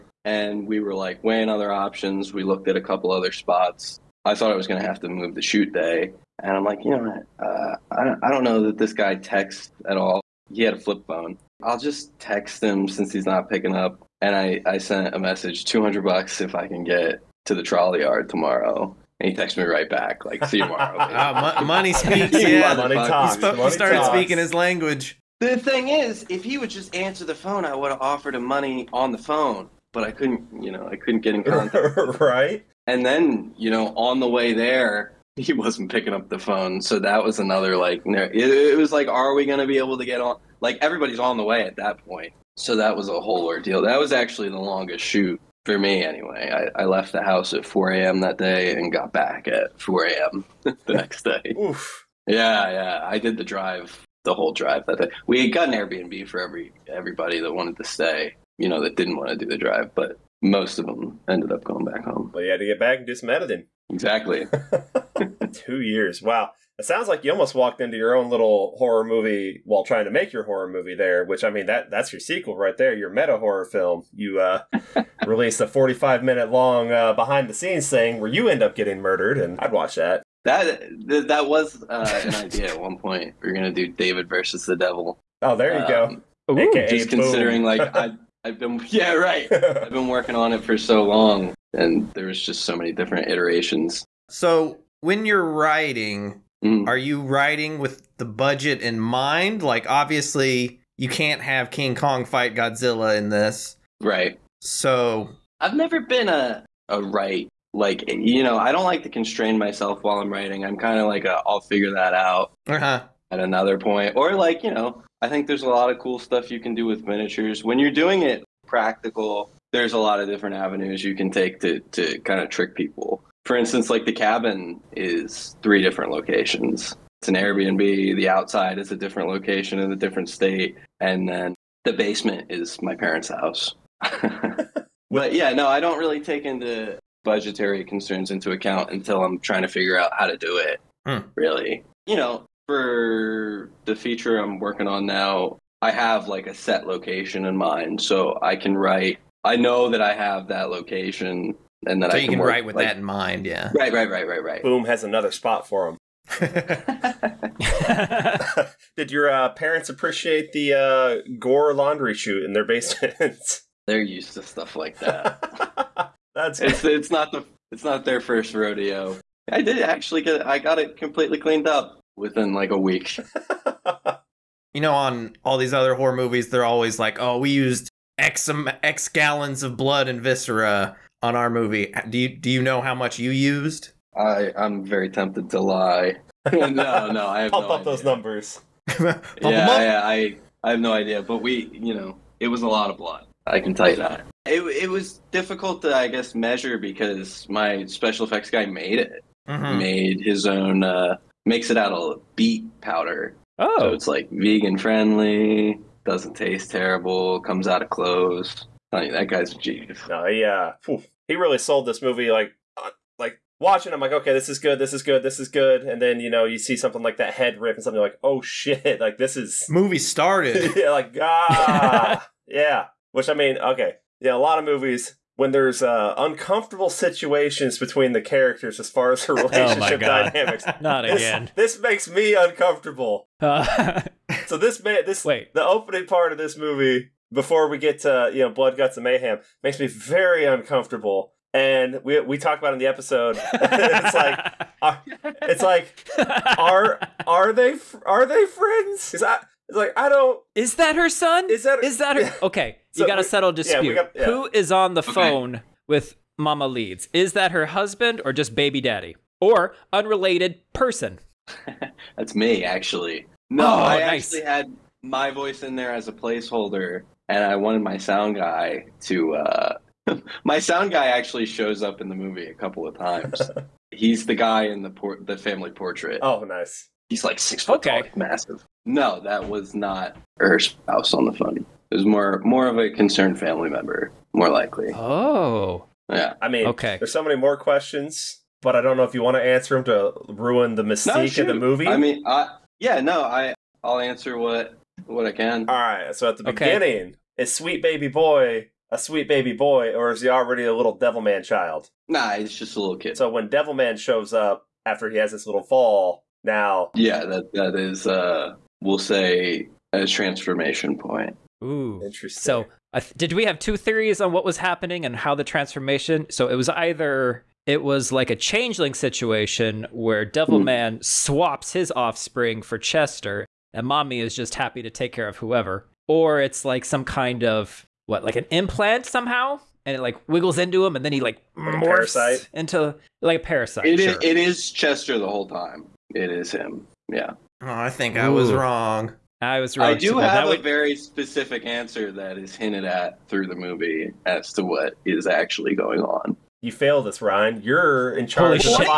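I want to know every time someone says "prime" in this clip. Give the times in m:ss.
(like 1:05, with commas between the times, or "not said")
not said.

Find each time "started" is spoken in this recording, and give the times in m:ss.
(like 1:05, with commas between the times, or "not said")
0:23, 3:39.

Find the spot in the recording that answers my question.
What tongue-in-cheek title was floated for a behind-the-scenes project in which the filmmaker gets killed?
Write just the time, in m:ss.
1:23.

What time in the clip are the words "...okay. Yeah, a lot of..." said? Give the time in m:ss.
3:43.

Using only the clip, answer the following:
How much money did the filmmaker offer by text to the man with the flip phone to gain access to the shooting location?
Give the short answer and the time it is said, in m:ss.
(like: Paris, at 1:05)
$200, at 0:15.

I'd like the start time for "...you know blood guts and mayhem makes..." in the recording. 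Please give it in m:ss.
3:58.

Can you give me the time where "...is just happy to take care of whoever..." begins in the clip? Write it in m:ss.
5:24.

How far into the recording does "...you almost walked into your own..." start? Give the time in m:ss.
1:07.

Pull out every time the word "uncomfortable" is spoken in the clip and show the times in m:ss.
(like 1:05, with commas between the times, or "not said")
3:46, 3:52, 4:00.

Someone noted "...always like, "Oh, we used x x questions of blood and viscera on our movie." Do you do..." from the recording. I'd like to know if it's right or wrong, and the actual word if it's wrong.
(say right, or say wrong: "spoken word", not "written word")
wrong: "gallons", not "questions".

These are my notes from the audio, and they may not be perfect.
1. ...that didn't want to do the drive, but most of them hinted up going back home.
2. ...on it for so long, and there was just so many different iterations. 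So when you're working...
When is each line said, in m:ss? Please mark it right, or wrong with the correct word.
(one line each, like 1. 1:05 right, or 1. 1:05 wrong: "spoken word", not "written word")
1. 0:58 wrong: "ended", not "hinted"
2. 1:30 wrong: "writing", not "working".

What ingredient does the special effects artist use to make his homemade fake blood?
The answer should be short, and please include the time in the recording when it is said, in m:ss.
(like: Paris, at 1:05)
Beet powder, at 3:22.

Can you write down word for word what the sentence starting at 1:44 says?
So I've never been a a right like you know I don't like to constrain myself while I'm writing.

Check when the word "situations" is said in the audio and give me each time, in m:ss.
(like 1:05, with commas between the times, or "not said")
3:46, 5:18.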